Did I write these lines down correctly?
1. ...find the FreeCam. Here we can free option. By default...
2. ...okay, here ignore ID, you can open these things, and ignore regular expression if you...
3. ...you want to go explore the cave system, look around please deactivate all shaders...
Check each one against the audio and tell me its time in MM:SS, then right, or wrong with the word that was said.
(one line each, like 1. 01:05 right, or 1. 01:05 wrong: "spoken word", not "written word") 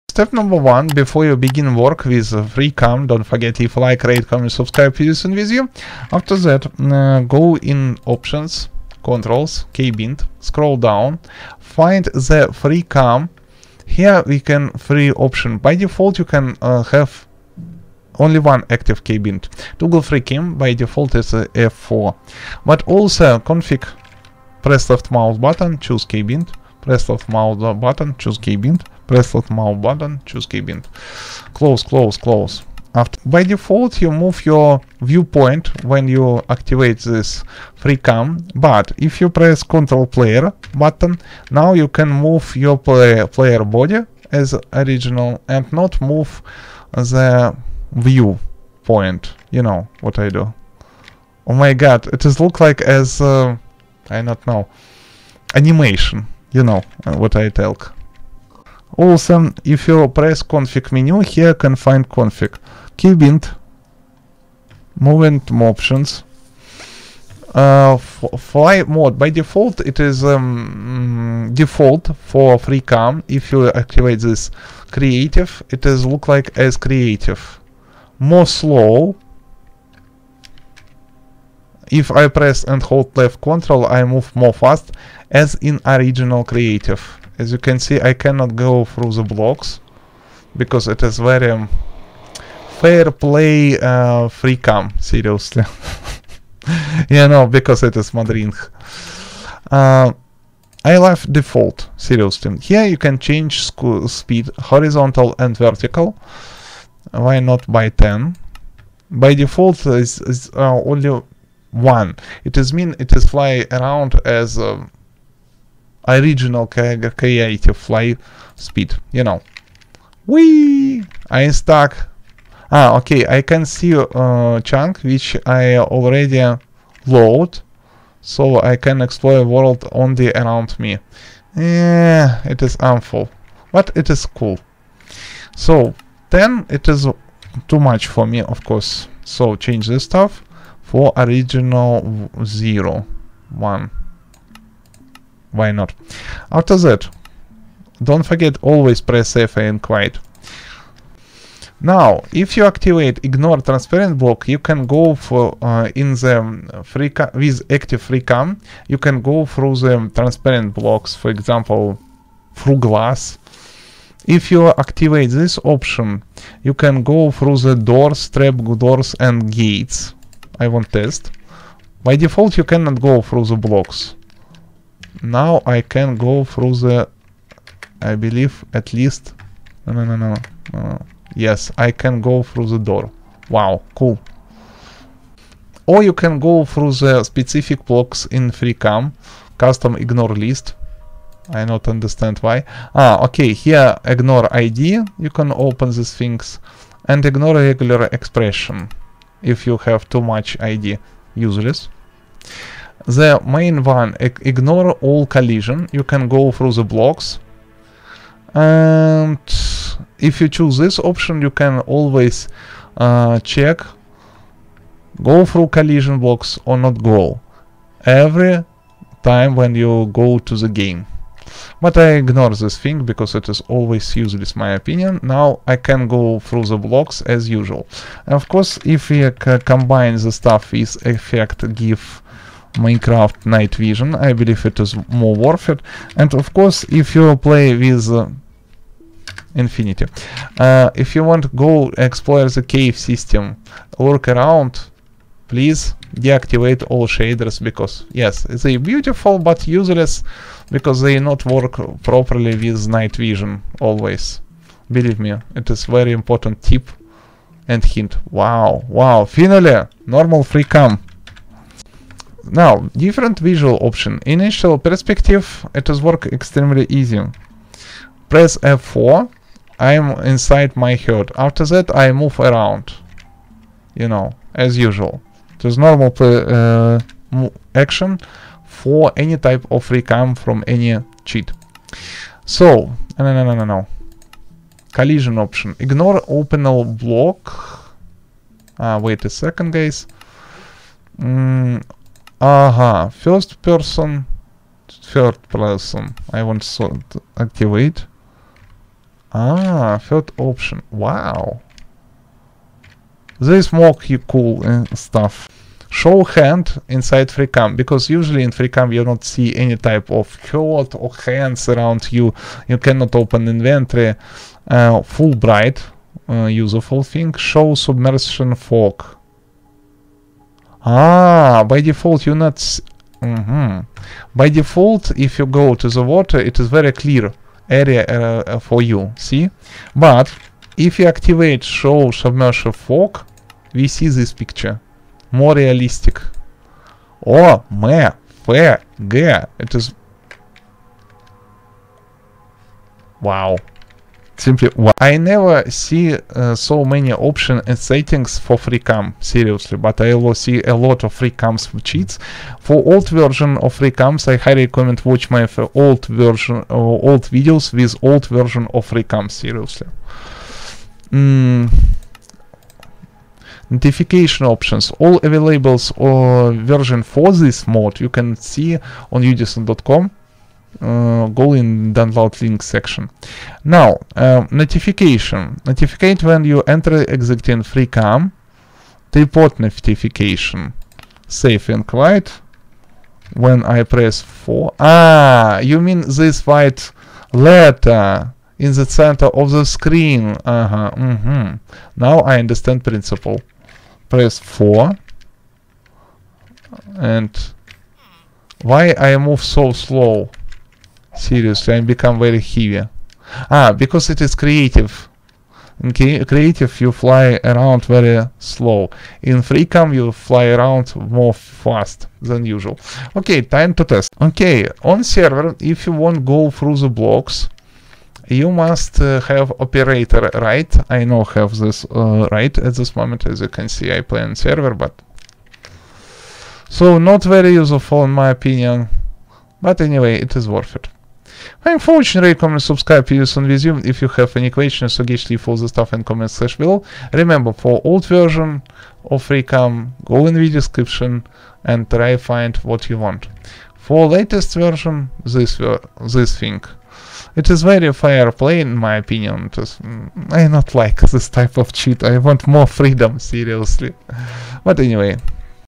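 1. 00:11 right
2. 03:13 right
3. 04:01 right.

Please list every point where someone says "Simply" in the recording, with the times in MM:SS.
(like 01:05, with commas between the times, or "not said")
05:44.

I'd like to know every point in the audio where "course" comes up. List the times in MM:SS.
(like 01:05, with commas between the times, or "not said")
02:18, 03:48, 03:56.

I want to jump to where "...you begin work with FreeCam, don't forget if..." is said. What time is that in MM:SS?
00:01.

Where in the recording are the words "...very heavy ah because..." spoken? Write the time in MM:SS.
06:42.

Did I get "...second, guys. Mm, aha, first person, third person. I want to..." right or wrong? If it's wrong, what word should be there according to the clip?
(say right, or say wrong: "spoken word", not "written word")
right.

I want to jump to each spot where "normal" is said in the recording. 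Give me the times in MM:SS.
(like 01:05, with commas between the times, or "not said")
04:20, 04:35.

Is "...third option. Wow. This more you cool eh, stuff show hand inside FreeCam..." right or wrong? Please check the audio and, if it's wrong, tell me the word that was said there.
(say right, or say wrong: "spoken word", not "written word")
right.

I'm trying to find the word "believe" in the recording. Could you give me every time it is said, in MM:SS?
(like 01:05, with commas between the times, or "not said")
02:58, 03:54, 04:14.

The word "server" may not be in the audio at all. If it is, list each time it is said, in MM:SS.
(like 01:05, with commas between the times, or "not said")
06:55, 07:04.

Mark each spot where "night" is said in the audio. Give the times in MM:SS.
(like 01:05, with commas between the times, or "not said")
03:53, 04:12.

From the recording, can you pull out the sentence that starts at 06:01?
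Mm notification options all available or uh, version for this mod you can see on udisen.com uh, go in download link section.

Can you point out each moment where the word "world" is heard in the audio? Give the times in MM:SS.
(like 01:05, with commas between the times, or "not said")
02:09.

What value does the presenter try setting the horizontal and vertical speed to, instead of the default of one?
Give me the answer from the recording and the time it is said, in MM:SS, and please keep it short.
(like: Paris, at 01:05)
10, at 01:47.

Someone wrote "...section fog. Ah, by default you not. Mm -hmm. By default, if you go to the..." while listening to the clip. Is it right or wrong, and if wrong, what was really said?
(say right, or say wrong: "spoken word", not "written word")
wrong: "submersion", not "section".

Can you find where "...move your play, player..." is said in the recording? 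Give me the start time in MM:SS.
00:42.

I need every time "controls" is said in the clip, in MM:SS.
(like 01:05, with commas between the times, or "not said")
00:09, 00:39, 01:23.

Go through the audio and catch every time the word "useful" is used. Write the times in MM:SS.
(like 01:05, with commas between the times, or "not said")
05:16, 07:07.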